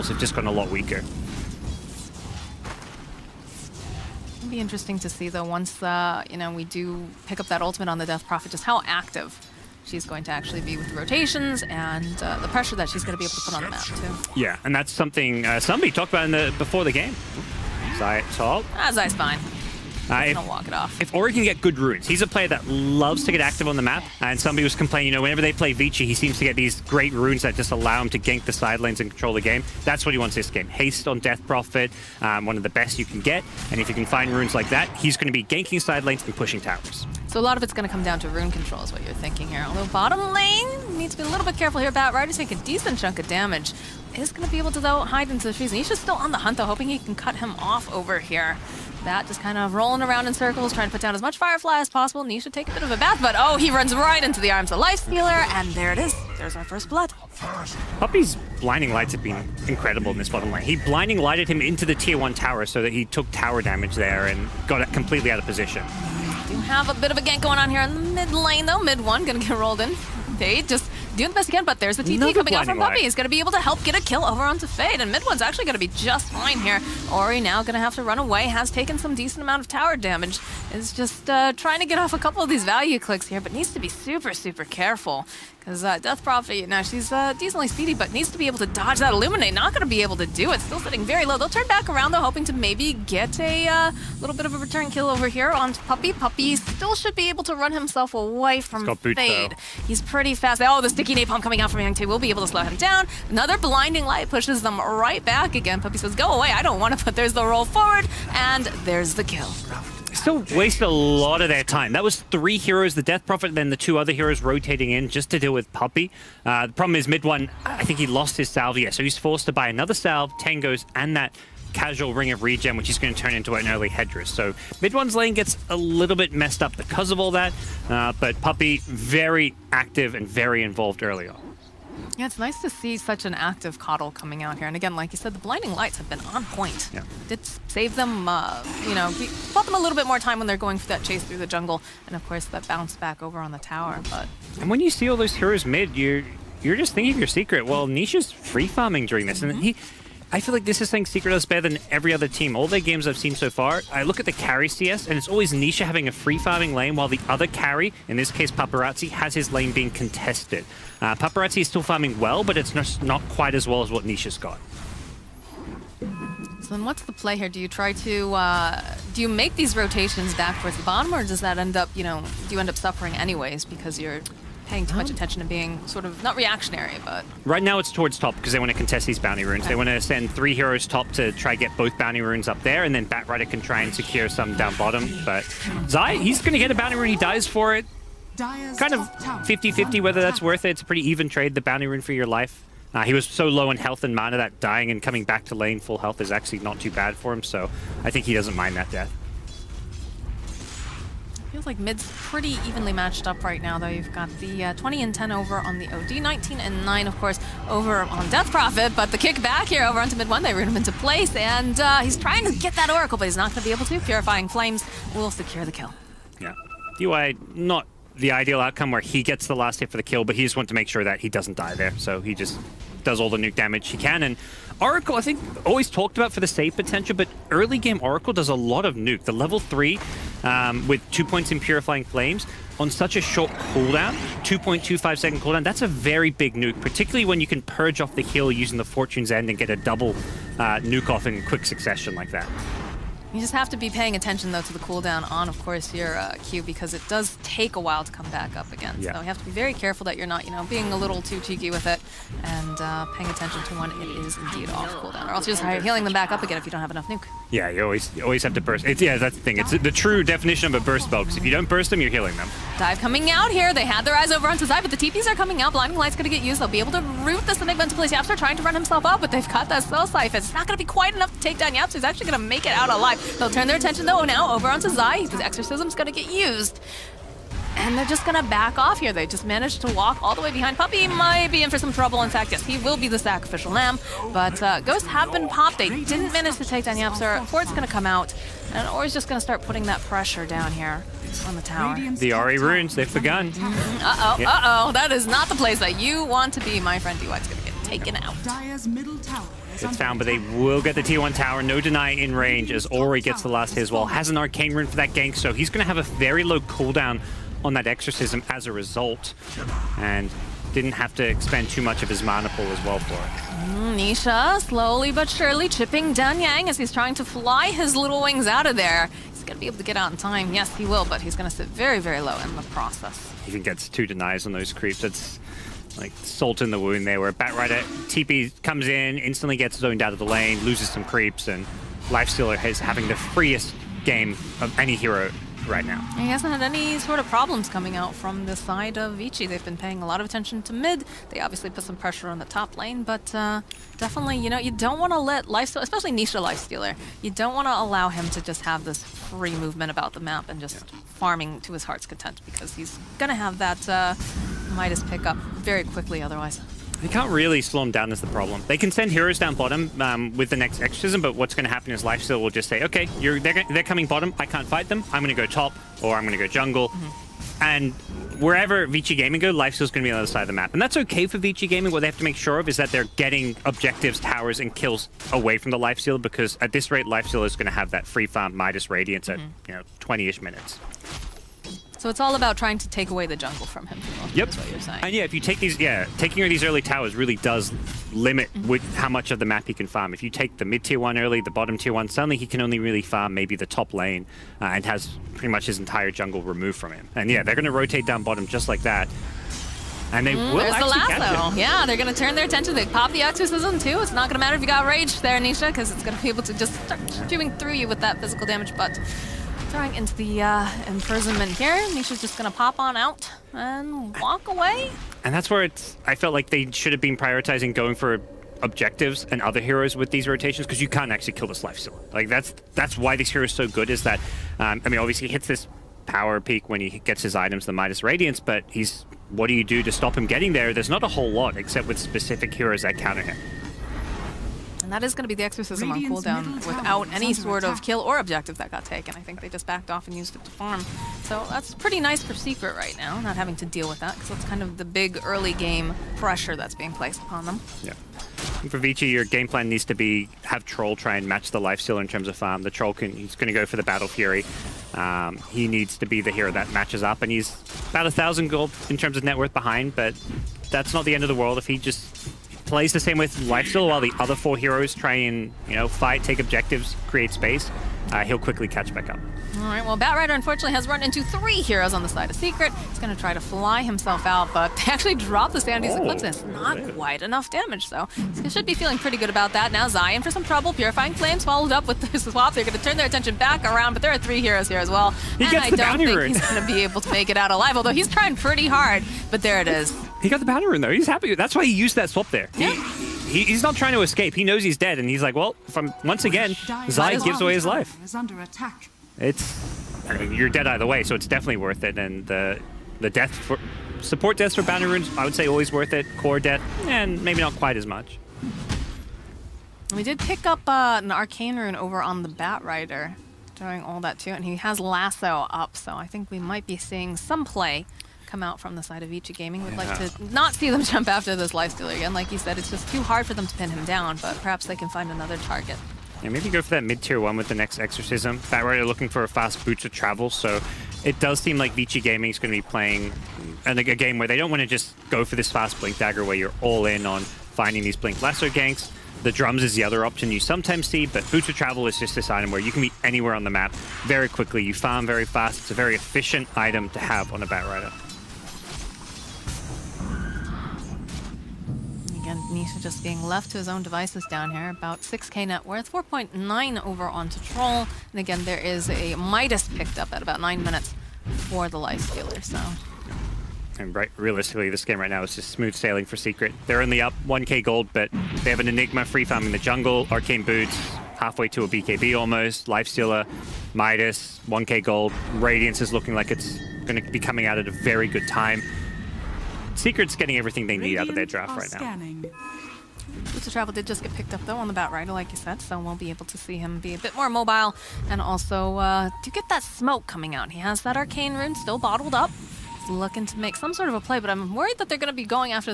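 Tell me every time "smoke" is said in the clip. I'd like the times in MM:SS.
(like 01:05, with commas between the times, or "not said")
09:49.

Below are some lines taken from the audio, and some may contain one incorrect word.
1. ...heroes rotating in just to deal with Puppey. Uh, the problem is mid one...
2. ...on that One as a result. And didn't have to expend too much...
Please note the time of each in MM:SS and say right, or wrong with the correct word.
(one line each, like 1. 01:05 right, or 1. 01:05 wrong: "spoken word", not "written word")
1. 01:54 right
2. 05:07 wrong: "Exorcism", not "One".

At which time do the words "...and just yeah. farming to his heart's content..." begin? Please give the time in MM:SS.
05:50.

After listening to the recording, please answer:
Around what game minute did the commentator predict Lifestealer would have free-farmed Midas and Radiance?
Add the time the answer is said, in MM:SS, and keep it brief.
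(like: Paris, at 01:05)
20, at 06:20.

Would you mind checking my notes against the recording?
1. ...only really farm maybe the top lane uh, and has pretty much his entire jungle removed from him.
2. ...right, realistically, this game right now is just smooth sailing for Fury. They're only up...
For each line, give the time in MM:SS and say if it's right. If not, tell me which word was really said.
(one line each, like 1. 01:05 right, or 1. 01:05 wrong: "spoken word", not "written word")
1. 06:32 right
2. 09:23 wrong: "Secret", not "Fury".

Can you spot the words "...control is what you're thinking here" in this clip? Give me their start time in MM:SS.
00:38.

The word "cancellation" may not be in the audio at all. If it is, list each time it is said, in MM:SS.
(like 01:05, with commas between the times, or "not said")
not said.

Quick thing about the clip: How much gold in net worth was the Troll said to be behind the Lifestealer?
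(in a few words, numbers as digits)
1000.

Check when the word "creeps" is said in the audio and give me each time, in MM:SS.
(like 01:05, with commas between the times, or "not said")
05:24, 05:31.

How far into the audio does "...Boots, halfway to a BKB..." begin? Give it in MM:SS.
09:30.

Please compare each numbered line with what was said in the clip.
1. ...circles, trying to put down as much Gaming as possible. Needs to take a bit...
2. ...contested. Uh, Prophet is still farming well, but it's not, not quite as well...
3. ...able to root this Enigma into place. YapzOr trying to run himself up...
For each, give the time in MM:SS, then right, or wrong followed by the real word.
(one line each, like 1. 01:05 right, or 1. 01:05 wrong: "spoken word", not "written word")
1. 00:50 wrong: "Firefly", not "Gaming"
2. 02:39 wrong: "Paparazi", not "Prophet"
3. 04:26 right.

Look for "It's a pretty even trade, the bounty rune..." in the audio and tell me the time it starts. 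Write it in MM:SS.
03:10.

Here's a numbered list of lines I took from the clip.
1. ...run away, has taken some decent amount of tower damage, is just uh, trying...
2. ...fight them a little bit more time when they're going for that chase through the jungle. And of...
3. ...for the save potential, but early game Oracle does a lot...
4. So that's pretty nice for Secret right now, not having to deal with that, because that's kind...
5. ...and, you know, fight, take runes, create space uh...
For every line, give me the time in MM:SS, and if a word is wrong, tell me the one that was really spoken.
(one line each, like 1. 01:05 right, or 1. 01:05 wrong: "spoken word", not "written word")
1. 01:18 right
2. 02:19 wrong: "bought", not "fight"
3. 03:46 right
4. 07:21 right
5. 07:45 wrong: "objectives", not "runes".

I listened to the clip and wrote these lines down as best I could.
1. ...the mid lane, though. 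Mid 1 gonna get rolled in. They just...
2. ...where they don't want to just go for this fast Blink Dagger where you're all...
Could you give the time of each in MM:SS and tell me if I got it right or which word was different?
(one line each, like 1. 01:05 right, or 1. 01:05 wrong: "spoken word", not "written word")
1. 01:07 right
2. 08:54 right.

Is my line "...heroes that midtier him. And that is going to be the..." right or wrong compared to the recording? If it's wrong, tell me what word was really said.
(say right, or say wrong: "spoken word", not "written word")
wrong: "counter", not "midtier".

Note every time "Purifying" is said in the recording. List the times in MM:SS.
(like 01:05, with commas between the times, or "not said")
03:33, 03:51, 08:00.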